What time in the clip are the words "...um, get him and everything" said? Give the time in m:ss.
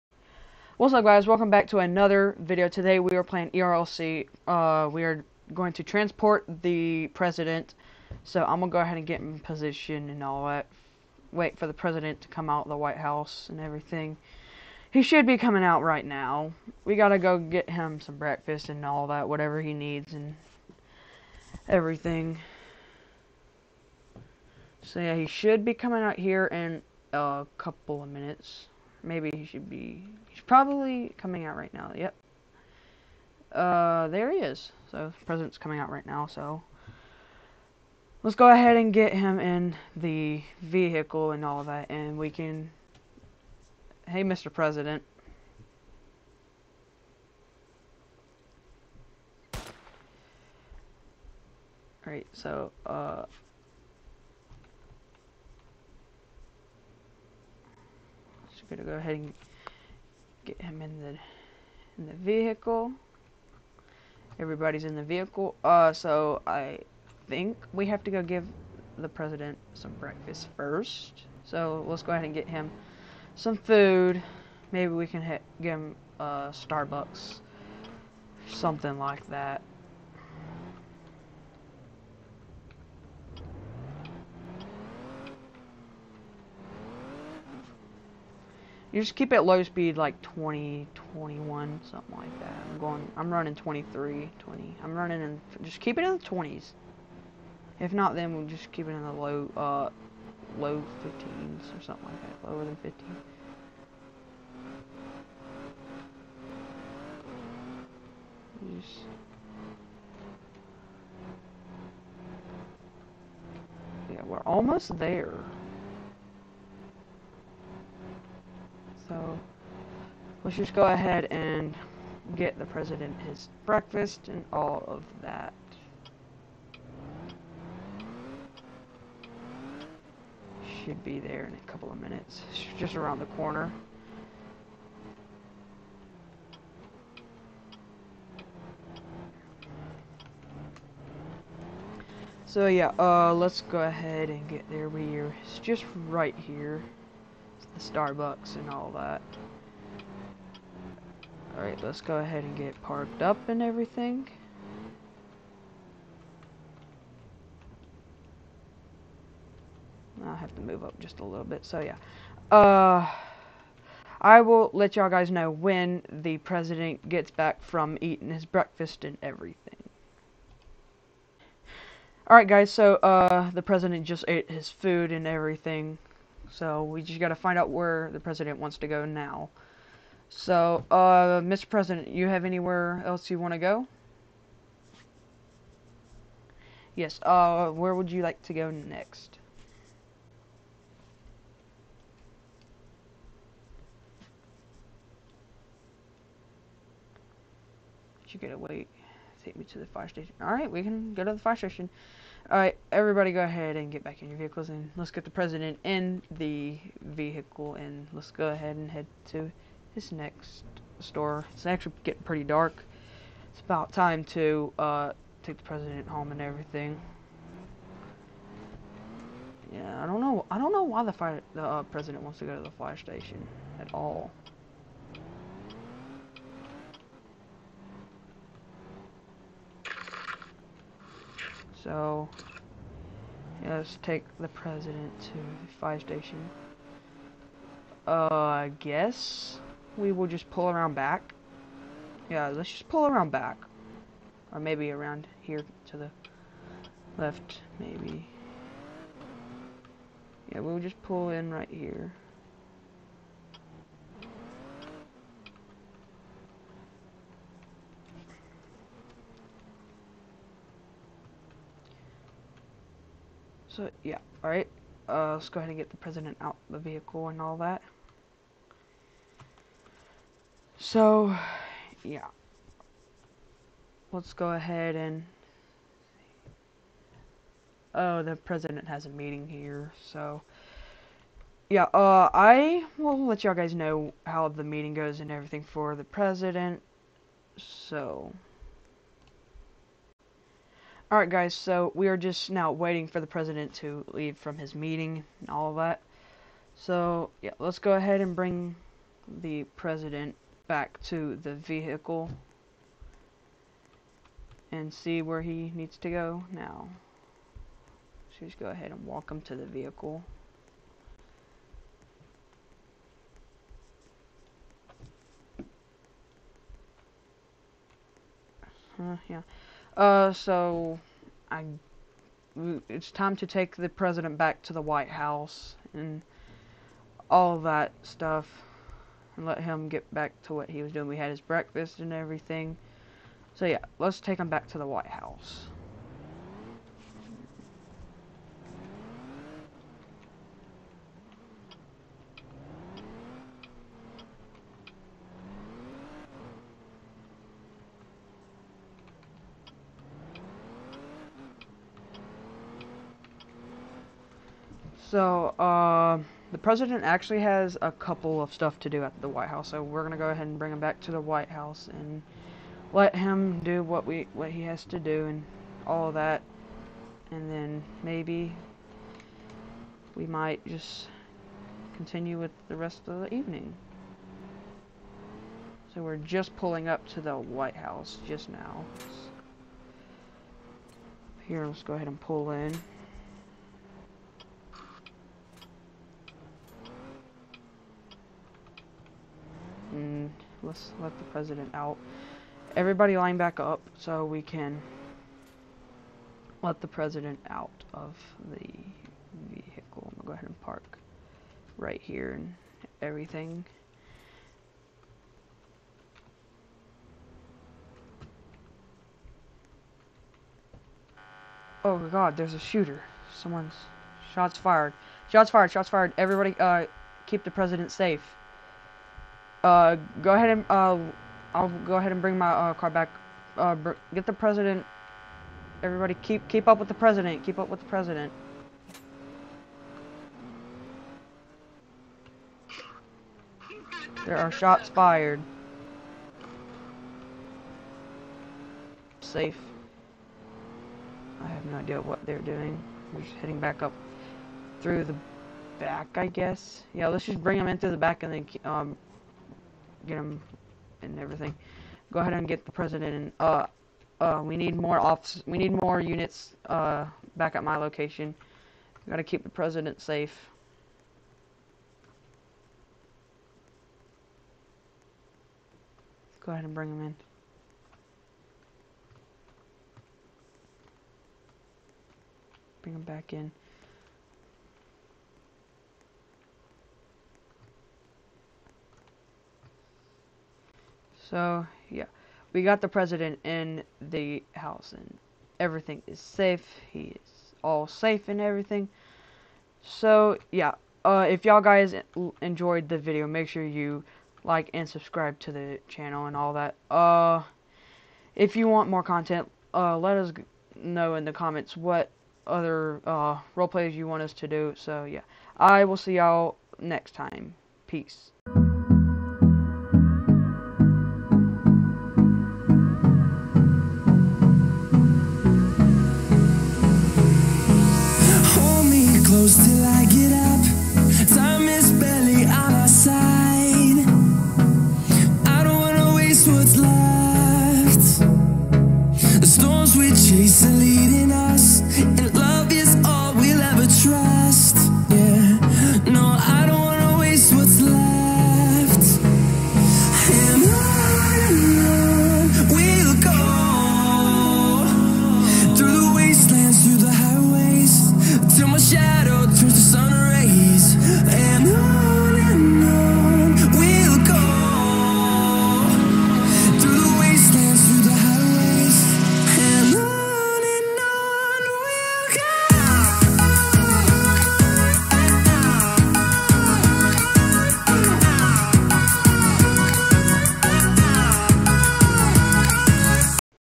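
7:28.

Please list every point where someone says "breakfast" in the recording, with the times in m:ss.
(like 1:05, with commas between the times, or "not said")
0:18, 1:09, 2:03, 2:48, 5:31.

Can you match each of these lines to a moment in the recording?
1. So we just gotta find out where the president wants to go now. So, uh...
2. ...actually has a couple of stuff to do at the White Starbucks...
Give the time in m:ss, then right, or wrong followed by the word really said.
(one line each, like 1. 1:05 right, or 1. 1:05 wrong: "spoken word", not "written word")
1. 2:56 right
2. 5:57 wrong: "House", not "Starbucks".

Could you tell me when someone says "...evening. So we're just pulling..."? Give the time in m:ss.
6:13.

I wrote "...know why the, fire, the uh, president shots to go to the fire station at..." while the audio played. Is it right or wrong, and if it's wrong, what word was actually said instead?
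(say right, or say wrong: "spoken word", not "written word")
wrong: "wants", not "shots".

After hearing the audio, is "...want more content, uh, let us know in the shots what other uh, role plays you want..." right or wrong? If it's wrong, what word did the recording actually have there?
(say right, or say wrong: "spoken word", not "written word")
wrong: "comments", not "shots".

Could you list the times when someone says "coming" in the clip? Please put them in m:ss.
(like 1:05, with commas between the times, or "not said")
0:15, 0:25, 0:31, 0:35.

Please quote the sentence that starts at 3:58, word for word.
Uh, I guess we will just pull around back.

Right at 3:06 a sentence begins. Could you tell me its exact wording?
Yes, uh, where would you like to go next?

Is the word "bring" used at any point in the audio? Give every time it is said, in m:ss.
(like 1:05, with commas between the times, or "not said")
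4:58, 6:00, 7:02, 7:27, 7:46, 7:52.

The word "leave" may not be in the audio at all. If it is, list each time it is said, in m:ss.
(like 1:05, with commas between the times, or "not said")
4:54.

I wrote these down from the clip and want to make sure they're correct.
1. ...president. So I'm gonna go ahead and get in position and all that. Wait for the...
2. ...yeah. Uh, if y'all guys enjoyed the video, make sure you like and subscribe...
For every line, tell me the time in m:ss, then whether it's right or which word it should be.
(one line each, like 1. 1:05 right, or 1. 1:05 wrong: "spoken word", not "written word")
1. 0:07 right
2. 8:10 right.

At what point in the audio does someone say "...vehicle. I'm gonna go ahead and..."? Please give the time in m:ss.
6:39.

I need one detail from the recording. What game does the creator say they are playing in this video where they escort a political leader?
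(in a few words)
ERLC.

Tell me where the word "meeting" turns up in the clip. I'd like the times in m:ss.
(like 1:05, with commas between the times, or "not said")
4:39, 4:44, 4:54.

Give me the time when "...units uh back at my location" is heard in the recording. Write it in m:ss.
7:35.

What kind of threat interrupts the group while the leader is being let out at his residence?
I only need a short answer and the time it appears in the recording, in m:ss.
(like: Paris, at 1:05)
a shooter, at 6:52.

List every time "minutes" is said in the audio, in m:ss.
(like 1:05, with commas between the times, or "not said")
0:28, 2:12.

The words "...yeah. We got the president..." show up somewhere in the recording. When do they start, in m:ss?
8:01.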